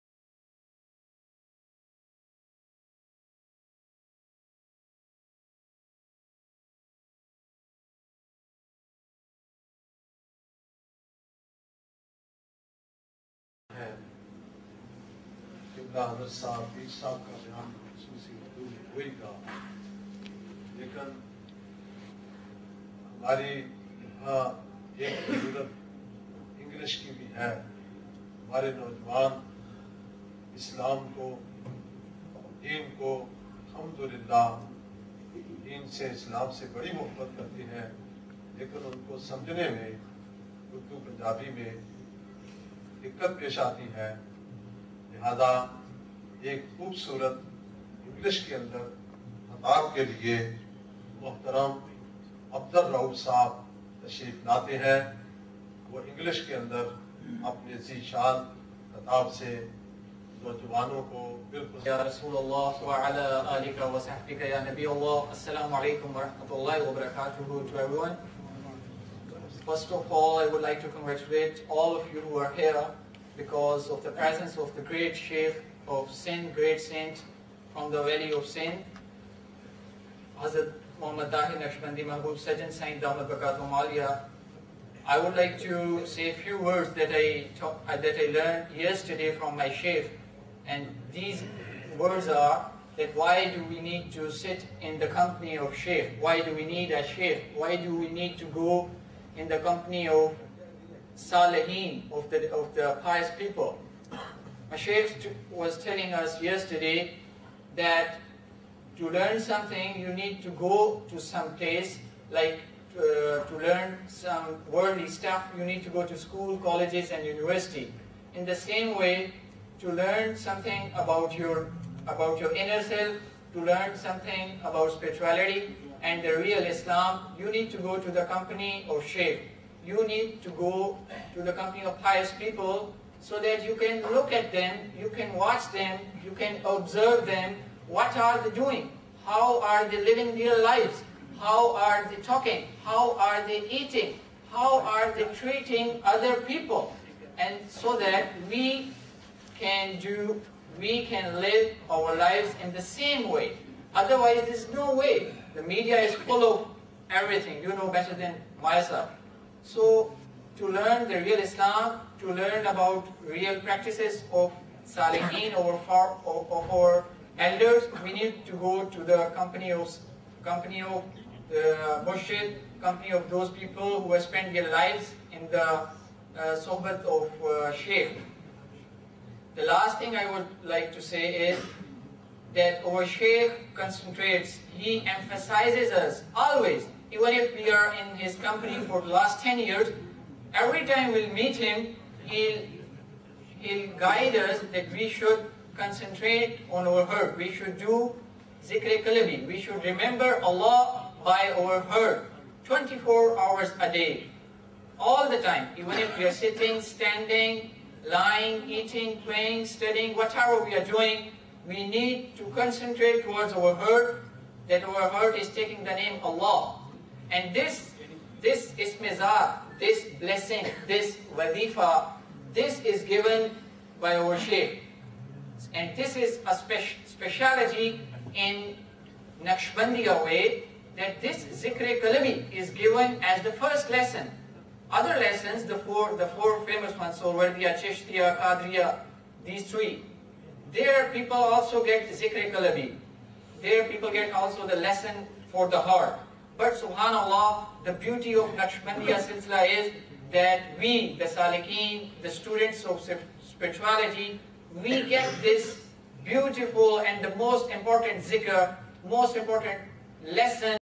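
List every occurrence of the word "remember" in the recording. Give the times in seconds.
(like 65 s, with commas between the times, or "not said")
199 s.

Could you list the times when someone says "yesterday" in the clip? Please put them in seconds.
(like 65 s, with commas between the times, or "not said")
88 s, 106 s.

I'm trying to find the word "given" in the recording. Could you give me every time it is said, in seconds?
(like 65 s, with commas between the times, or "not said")
223 s, 232 s.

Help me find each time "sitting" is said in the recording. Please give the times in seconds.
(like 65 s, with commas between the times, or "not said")
206 s.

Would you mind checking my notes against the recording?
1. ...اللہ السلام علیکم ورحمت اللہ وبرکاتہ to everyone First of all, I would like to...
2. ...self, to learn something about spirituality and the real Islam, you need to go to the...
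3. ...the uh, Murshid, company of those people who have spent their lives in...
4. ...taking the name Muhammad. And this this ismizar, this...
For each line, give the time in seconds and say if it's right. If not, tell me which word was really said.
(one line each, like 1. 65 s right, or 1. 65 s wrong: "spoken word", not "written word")
1. 64 s right
2. 122 s right
3. 171 s right
4. 215 s wrong: "Allah", not "Muhammad".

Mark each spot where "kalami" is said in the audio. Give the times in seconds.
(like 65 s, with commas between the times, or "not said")
232 s, 242 s.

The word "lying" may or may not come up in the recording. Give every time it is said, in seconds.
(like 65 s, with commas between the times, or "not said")
208 s.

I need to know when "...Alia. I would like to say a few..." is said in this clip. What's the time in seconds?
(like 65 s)
83 s.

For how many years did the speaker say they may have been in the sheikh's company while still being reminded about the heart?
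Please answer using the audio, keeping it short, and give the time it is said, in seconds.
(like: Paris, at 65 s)
10, at 189 s.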